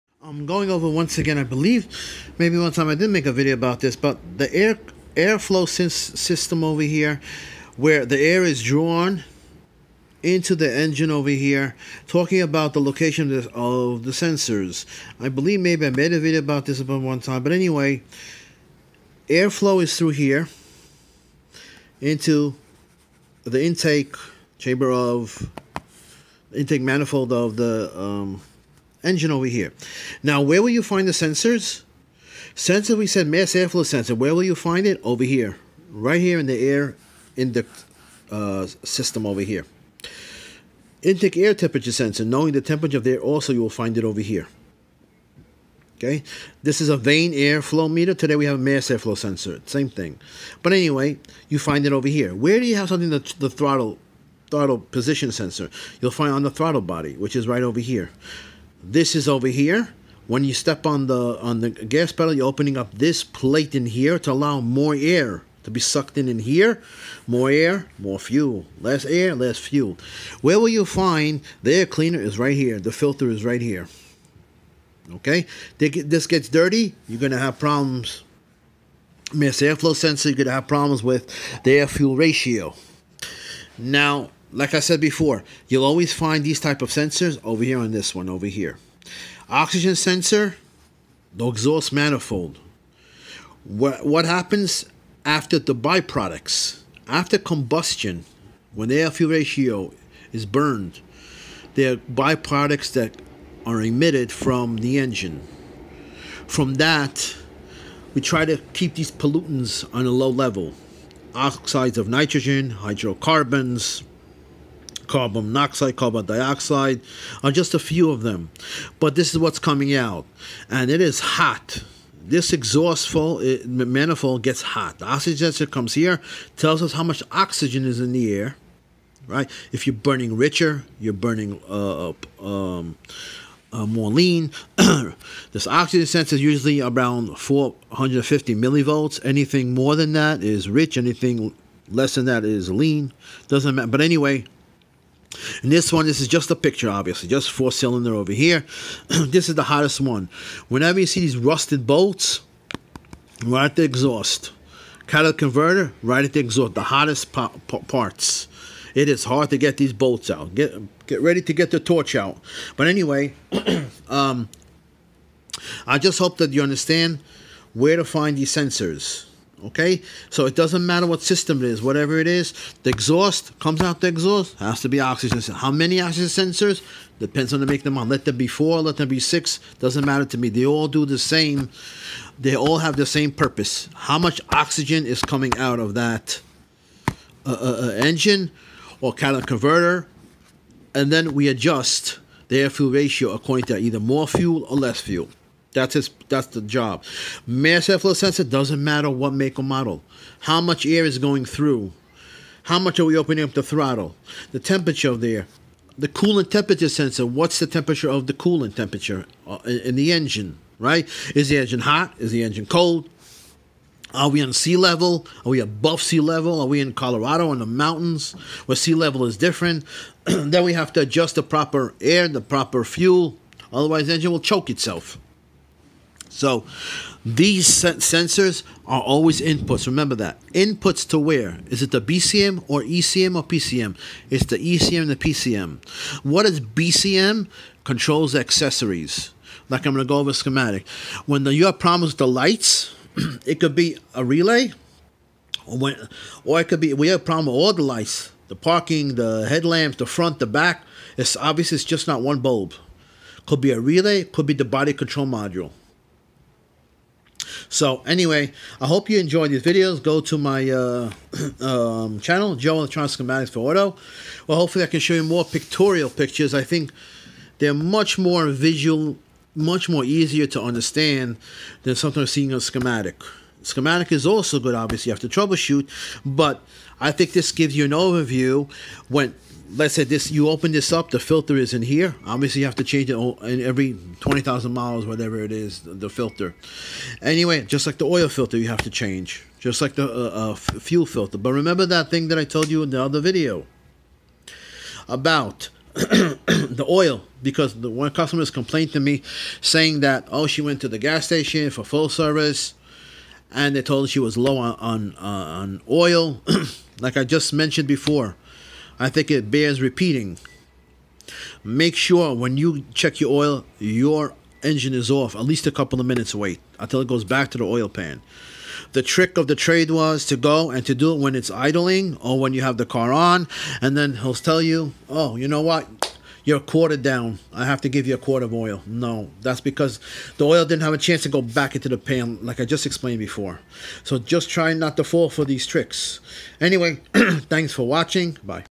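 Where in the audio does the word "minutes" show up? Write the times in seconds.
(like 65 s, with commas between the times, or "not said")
316 s.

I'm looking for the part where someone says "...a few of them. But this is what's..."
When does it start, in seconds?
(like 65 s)
117 s.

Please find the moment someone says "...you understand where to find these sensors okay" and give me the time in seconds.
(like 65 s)
166 s.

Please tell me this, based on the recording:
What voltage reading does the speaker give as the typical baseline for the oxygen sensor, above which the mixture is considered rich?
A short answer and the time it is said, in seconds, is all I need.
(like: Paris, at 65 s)
450 millivolts, at 137 s.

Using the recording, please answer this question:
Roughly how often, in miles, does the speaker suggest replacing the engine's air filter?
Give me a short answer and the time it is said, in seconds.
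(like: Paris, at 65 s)
20,000 miles, at 284 s.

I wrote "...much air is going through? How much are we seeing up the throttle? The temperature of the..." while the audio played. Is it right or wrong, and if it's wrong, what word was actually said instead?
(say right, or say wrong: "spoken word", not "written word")
wrong: "opening", not "seeing".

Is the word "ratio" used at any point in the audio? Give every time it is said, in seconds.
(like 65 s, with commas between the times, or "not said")
82 s, 99 s, 192 s.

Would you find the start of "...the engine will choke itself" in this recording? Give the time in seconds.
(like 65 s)
224 s.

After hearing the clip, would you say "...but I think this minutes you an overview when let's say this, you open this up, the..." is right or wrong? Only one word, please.
wrong.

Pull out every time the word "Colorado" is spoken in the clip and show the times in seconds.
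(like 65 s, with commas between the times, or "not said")
216 s.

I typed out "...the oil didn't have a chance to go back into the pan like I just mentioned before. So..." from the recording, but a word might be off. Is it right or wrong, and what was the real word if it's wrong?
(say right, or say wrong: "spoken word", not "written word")
wrong: "explained", not "mentioned".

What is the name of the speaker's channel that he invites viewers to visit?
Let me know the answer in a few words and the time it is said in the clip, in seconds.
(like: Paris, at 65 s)
Joe Electronic Schematics for Auto, at 262 s.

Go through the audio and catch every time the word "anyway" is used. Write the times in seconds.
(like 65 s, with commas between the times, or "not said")
17 s, 50 s, 143 s, 162 s, 258 s, 287 s, 336 s.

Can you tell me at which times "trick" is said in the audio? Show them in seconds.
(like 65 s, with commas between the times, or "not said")
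319 s, 335 s.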